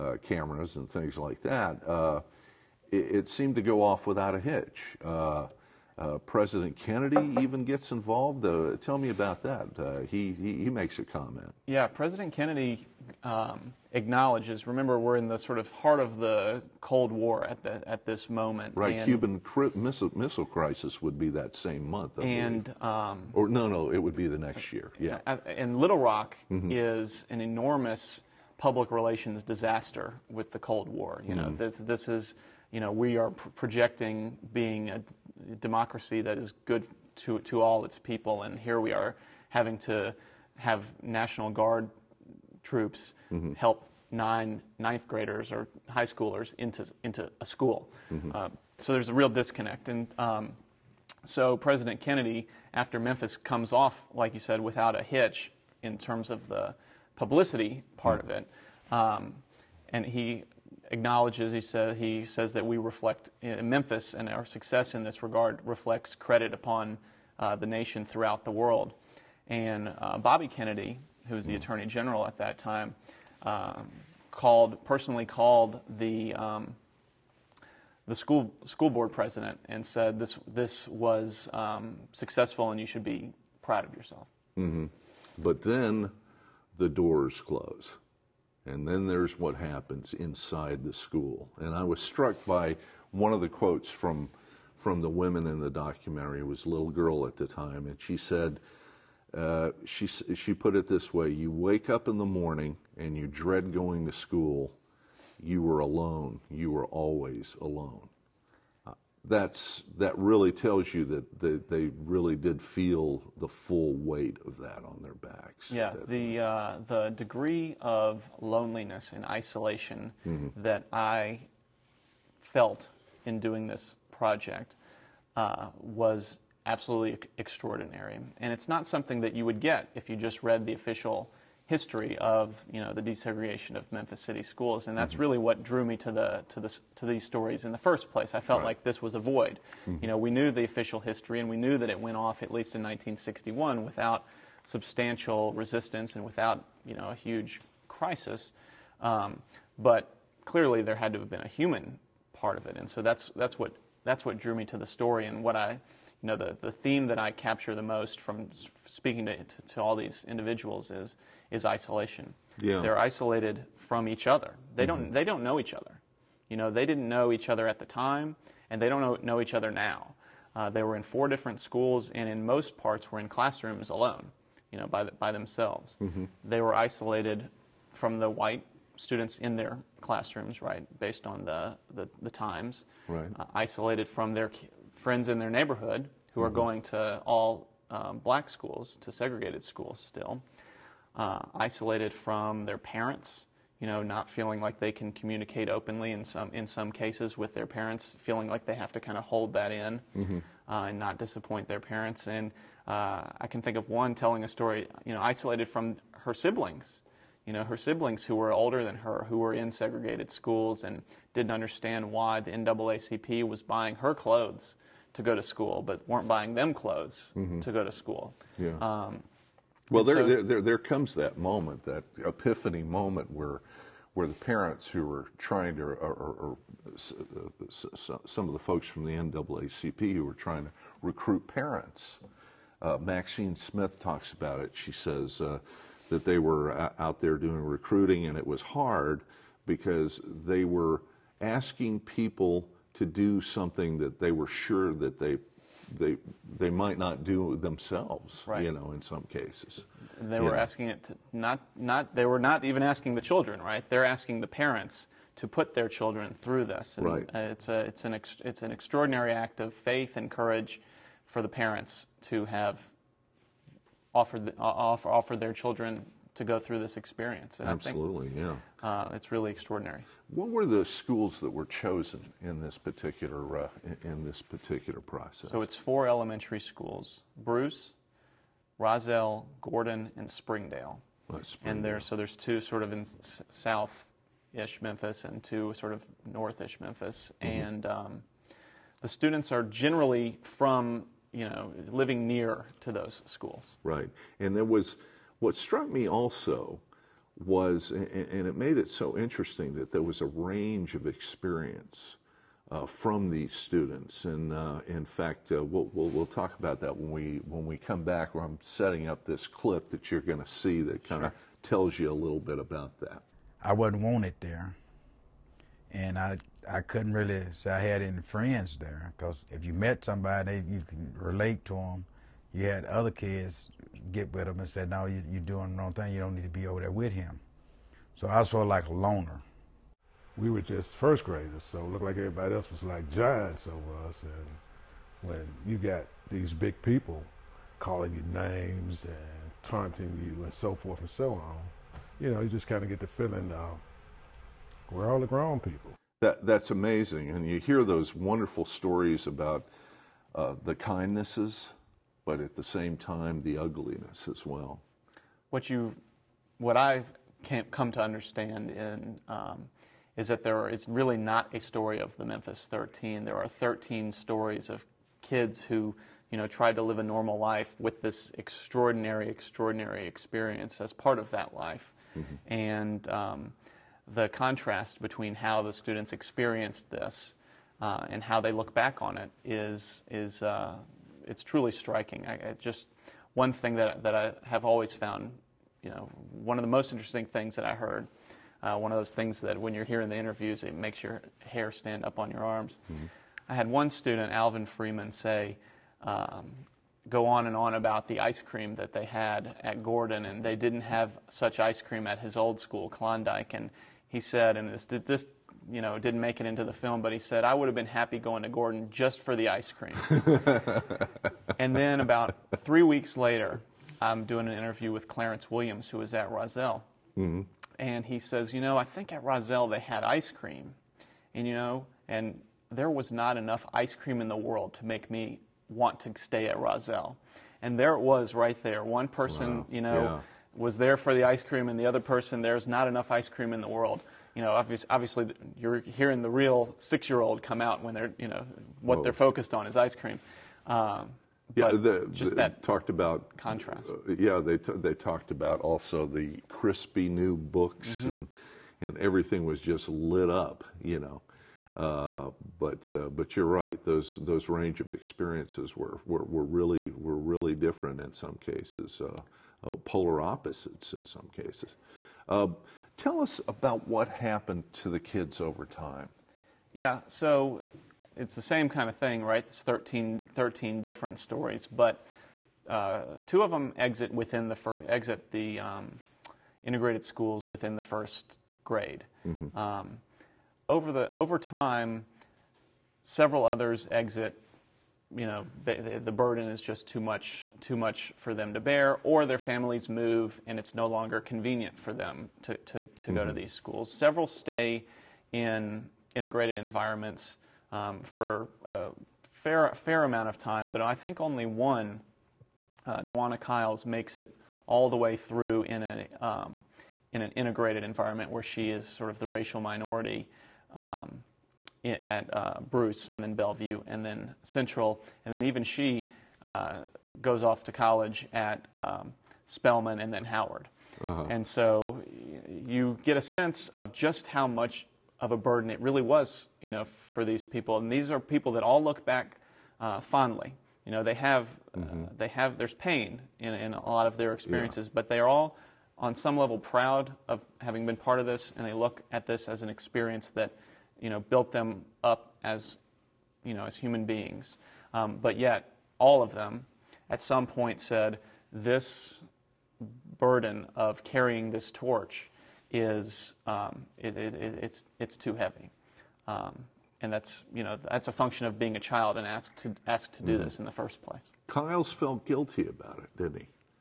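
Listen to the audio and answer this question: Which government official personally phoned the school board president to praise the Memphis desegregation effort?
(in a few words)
Bobby Kennedy.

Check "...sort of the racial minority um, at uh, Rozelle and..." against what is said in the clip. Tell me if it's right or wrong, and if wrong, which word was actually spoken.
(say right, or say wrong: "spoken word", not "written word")
wrong: "Bruce", not "Rozelle".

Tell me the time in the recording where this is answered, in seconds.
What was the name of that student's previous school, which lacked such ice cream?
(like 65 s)
402 s.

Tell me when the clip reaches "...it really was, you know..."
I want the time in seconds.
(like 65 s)
525 s.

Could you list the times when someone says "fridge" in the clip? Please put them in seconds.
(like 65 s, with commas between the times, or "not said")
not said.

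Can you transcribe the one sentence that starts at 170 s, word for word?
Uh, they were in four different schools, and in most parts were in classrooms alone, you know, by, the, by themselves.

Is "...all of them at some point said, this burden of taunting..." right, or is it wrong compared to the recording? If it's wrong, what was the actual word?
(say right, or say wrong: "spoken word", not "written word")
wrong: "carrying", not "taunting".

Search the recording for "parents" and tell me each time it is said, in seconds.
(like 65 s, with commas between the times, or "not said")
192 s, 197 s, 201 s, 224 s, 231 s, 254 s, 261 s.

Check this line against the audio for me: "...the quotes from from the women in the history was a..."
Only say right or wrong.
wrong.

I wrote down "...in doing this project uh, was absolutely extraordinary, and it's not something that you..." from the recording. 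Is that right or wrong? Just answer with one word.
right.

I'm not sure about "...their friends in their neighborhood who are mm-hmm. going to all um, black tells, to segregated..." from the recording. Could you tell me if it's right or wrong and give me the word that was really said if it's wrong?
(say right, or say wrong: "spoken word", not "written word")
wrong: "schools", not "tells".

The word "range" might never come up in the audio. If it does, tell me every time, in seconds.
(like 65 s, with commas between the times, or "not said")
300 s, 454 s.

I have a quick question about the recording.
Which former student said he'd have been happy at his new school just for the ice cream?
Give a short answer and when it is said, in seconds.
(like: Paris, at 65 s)
Alvin Freeman, at 394 s.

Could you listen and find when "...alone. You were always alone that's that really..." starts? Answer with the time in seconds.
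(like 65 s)
105 s.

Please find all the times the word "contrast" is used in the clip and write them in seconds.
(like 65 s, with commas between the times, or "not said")
374 s, 443 s.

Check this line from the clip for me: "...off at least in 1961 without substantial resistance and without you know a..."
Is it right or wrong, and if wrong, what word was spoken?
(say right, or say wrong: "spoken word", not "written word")
right.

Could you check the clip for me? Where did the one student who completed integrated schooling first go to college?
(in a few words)
Spelman.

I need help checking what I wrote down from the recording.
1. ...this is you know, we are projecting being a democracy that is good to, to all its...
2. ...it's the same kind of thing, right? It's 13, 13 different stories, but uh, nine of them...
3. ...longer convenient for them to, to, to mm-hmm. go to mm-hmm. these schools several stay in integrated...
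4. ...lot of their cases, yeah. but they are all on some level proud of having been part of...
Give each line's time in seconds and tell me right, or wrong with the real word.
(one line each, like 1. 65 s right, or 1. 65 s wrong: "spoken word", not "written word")
1. 32 s right
2. 468 s wrong: "two", not "nine"
3. 490 s right
4. 533 s wrong: "experiences", not "cases".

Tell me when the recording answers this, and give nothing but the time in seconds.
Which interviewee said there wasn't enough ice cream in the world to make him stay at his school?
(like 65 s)
415 s.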